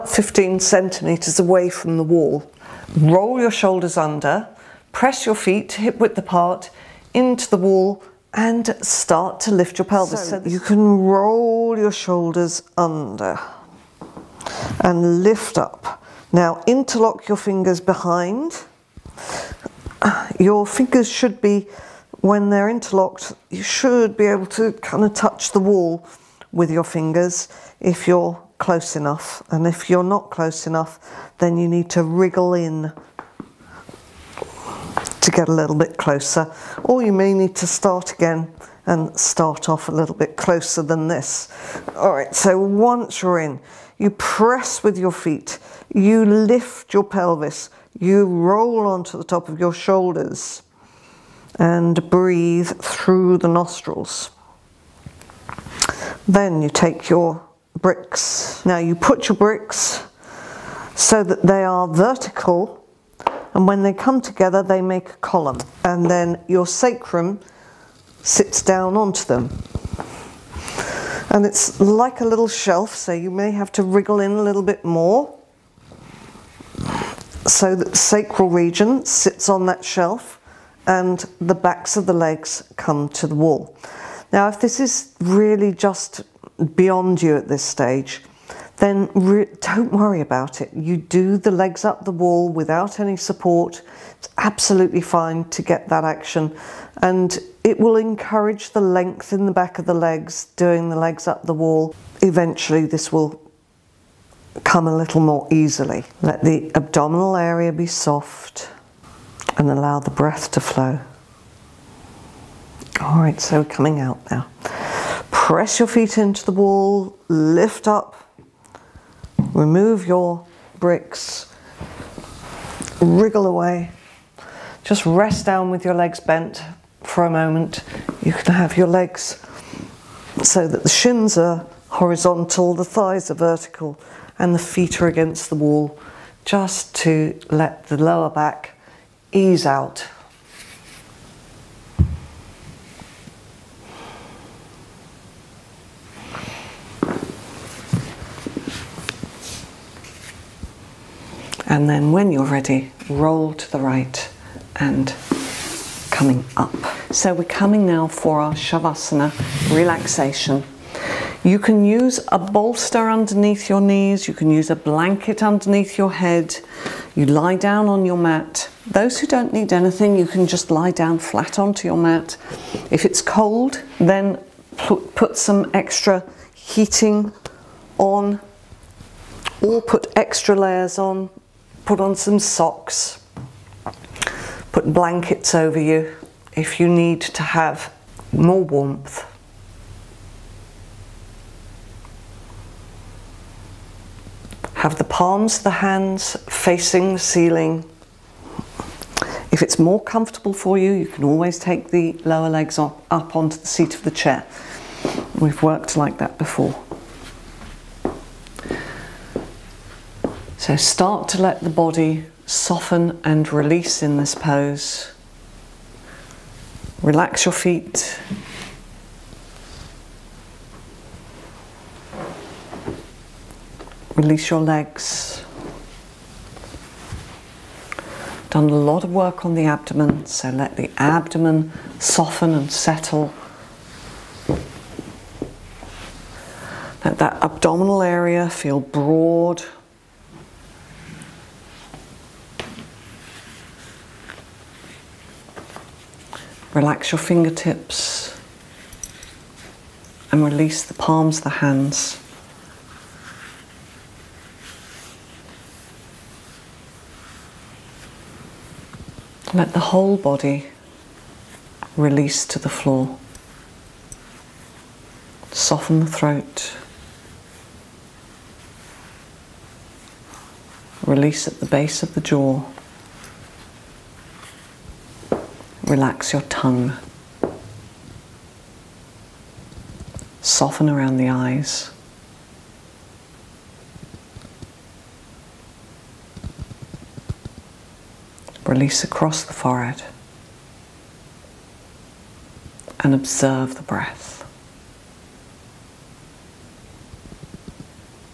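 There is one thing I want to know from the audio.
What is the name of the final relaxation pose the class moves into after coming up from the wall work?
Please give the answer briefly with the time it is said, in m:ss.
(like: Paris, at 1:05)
Shavasana, at 2:38.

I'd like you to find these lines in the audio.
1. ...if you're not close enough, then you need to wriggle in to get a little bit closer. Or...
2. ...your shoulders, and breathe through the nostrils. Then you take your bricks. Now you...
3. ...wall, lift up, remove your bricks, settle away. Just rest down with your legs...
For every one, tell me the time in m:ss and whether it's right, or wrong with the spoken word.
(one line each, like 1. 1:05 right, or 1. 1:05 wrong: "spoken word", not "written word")
1. 0:29 right
2. 0:49 right
3. 1:56 wrong: "wriggle", not "settle".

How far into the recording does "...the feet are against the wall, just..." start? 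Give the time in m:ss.
2:14.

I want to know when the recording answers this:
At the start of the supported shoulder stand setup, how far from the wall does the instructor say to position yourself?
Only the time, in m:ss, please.
0:00.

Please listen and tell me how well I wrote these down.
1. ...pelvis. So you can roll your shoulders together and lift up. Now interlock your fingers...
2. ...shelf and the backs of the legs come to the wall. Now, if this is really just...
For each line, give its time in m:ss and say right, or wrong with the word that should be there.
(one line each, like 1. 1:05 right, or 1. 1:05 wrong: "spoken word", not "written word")
1. 0:09 wrong: "under", not "together"
2. 1:19 right.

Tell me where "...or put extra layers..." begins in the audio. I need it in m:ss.
2:59.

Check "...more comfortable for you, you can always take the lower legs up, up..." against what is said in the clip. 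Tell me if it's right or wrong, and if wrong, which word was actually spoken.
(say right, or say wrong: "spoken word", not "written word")
right.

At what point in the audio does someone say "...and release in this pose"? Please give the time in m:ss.
3:33.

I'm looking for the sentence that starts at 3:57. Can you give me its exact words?
Let that abdominal area feel broad.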